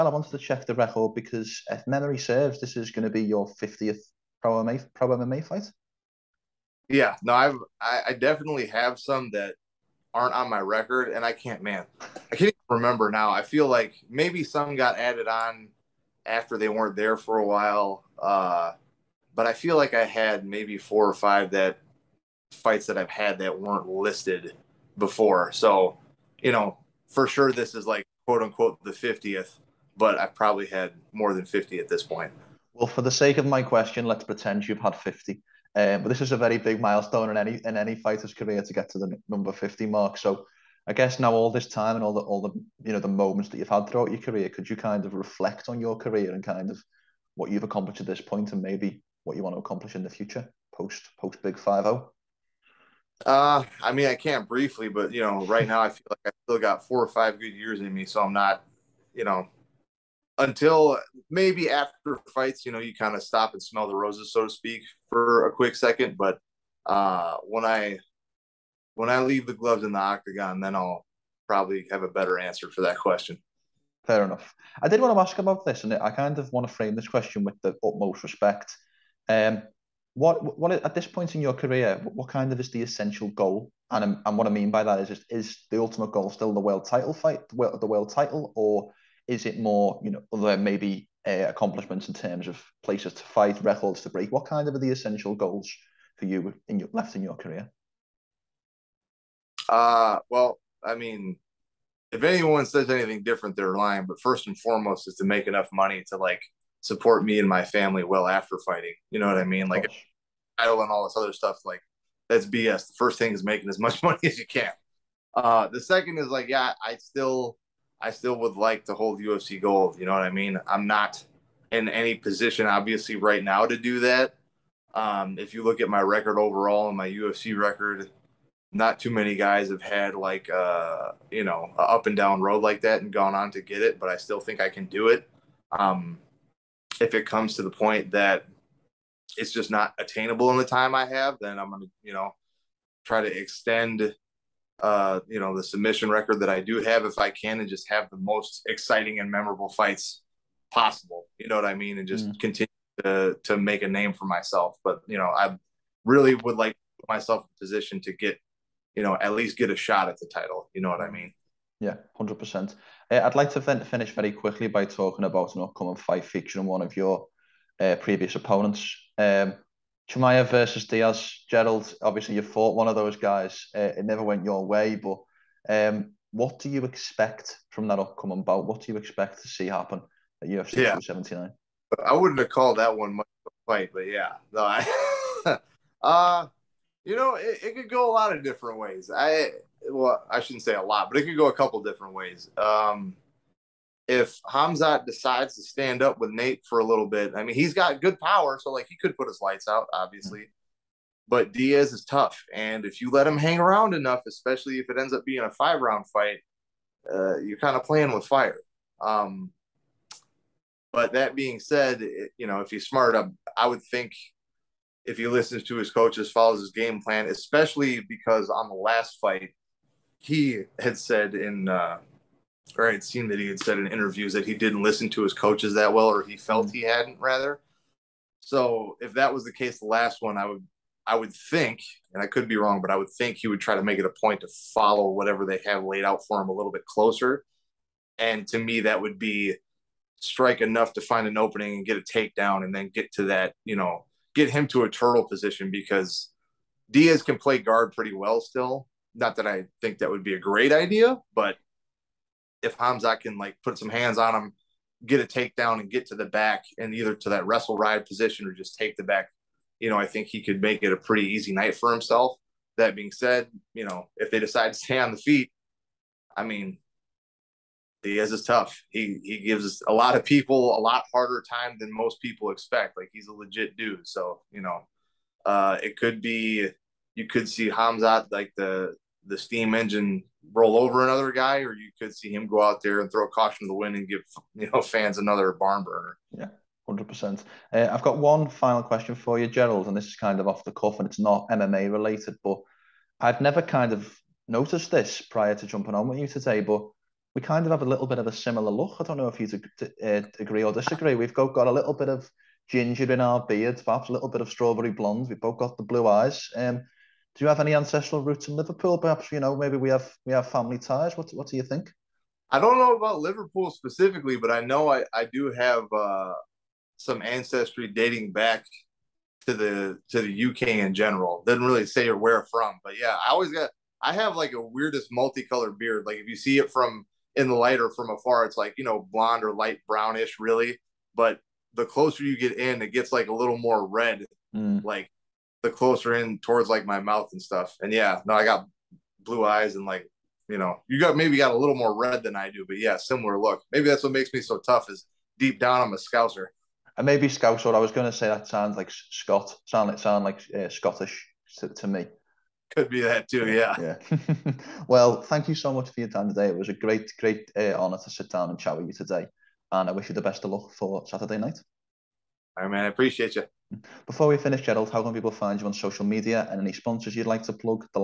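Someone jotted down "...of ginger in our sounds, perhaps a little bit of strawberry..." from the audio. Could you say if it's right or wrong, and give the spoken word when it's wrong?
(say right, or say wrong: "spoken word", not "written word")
wrong: "beards", not "sounds".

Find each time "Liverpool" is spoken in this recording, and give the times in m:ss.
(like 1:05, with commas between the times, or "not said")
5:08, 5:13.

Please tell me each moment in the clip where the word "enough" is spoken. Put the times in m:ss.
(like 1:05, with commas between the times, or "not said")
1:14, 1:45, 3:23, 4:00.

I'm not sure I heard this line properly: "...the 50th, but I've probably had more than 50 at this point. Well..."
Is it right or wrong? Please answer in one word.
right.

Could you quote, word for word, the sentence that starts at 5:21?
Doesn't really say or where from, but yeah, I always got I have like a weirdest multicolored beard.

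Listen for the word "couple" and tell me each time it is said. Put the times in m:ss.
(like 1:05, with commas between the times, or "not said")
3:11.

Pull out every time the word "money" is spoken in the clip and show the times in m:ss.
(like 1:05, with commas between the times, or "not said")
1:45, 1:54.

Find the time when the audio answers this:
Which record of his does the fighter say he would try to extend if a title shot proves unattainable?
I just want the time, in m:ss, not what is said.
2:25.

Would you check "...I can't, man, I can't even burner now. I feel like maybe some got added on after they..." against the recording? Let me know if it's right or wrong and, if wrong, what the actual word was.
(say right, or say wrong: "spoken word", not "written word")
wrong: "remember", not "burner".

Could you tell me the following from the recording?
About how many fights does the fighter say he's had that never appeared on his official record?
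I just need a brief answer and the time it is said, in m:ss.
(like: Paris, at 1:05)
4 or 5, at 0:20.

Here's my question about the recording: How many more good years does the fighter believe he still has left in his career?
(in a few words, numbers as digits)
4 or 5.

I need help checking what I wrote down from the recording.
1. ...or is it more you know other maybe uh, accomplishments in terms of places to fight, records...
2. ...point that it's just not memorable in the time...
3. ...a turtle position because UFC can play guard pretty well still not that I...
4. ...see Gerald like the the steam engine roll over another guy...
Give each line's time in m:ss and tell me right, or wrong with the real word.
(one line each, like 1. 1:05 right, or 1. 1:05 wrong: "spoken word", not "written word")
1. 1:28 right
2. 2:17 wrong: "attainable", not "memorable"
3. 4:04 wrong: "Diaz", not "UFC"
4. 4:37 wrong: "Khamzat", not "Gerald".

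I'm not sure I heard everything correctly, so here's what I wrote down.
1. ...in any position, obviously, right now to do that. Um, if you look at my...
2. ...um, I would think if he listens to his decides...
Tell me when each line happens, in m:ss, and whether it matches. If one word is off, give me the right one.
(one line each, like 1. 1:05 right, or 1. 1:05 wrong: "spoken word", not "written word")
1. 2:01 right
2. 3:33 wrong: "coaches", not "decides".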